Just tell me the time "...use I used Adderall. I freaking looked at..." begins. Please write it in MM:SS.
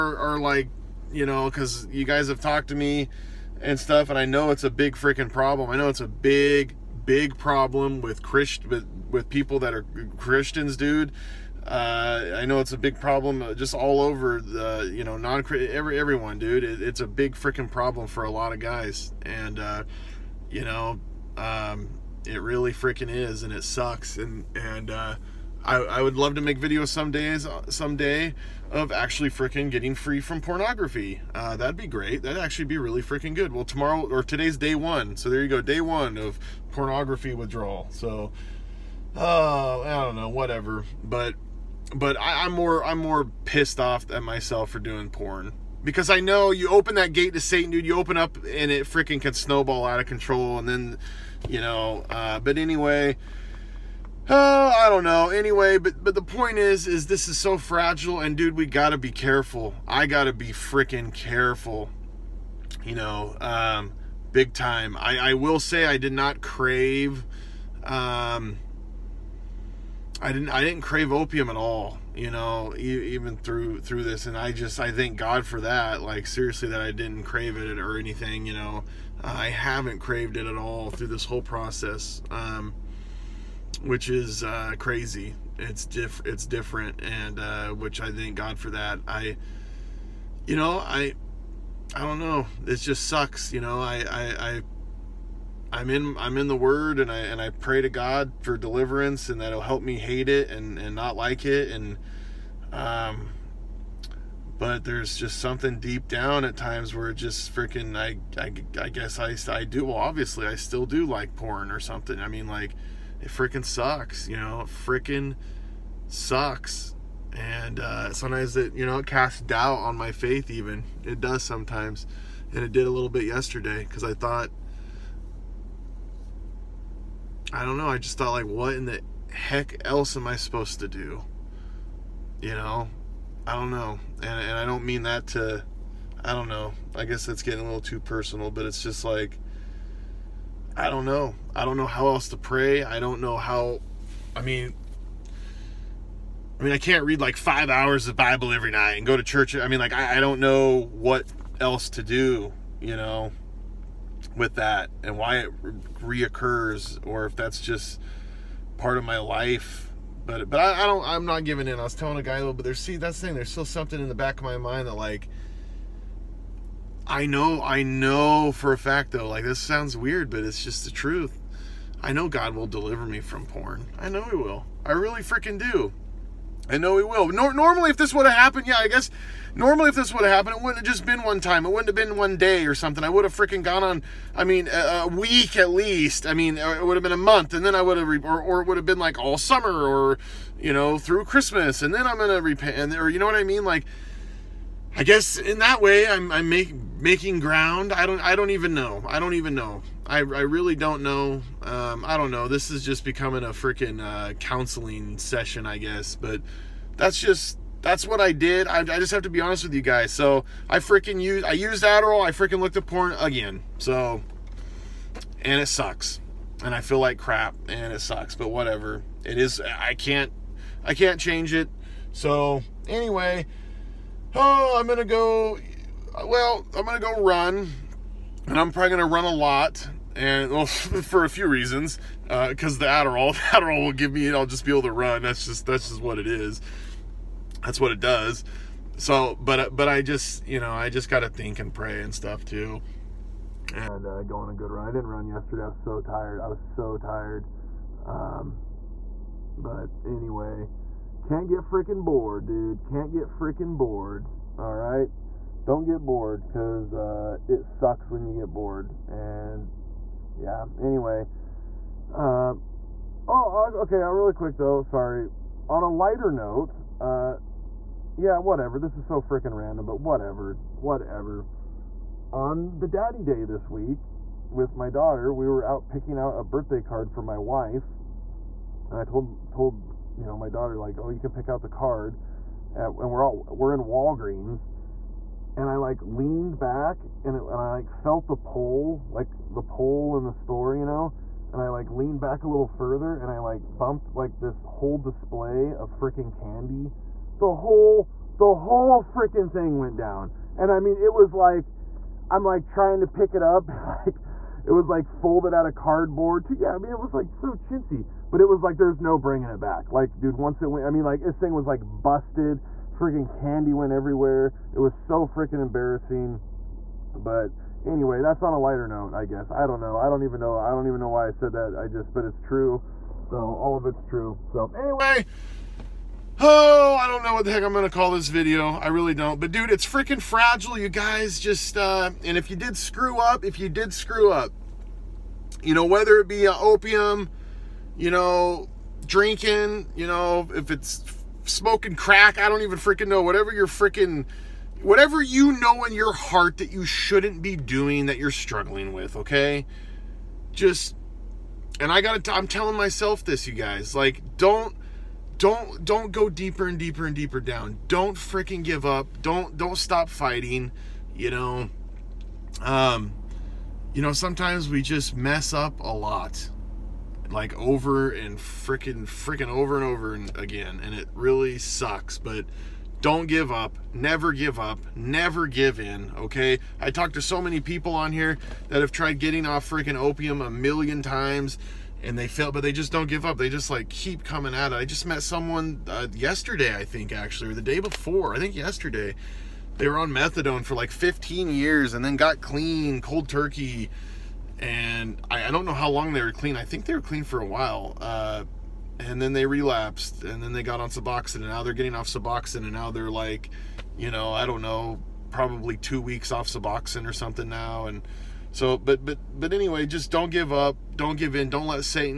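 03:31.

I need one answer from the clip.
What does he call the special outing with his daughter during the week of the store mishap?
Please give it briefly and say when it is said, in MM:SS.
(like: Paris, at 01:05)
Daddy day, at 04:32.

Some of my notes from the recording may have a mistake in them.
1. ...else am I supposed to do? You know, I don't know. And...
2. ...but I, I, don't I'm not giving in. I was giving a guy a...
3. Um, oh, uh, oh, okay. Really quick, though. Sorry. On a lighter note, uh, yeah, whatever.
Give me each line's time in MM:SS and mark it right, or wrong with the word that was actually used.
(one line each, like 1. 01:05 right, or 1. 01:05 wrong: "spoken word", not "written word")
1. 02:09 right
2. 02:40 wrong: "telling", not "giving"
3. 04:22 right.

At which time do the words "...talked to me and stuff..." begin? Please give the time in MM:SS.
00:02.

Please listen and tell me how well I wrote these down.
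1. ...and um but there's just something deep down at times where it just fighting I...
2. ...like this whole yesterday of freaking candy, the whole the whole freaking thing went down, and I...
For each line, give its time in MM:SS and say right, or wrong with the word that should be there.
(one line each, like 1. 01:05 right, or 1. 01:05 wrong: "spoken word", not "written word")
1. 01:41 wrong: "freaking", not "fighting"
2. 04:54 wrong: "display", not "yesterday".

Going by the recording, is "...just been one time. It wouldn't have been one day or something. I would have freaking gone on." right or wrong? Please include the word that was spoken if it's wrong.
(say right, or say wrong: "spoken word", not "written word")
right.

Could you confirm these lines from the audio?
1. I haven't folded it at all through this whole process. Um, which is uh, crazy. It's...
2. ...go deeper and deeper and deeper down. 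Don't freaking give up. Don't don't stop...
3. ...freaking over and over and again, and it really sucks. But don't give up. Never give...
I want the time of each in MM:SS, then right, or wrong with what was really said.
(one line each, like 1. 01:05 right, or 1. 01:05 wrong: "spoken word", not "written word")
1. 01:19 wrong: "craved", not "folded"
2. 05:56 right
3. 06:09 right.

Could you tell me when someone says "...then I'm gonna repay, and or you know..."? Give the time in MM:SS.
03:11.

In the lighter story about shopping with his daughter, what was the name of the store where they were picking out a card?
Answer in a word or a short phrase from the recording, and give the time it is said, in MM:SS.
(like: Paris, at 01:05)
Walgreens, at 04:43.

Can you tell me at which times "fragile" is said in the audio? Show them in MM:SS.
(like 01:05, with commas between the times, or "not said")
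00:57, 05:30.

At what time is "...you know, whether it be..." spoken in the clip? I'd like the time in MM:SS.
05:35.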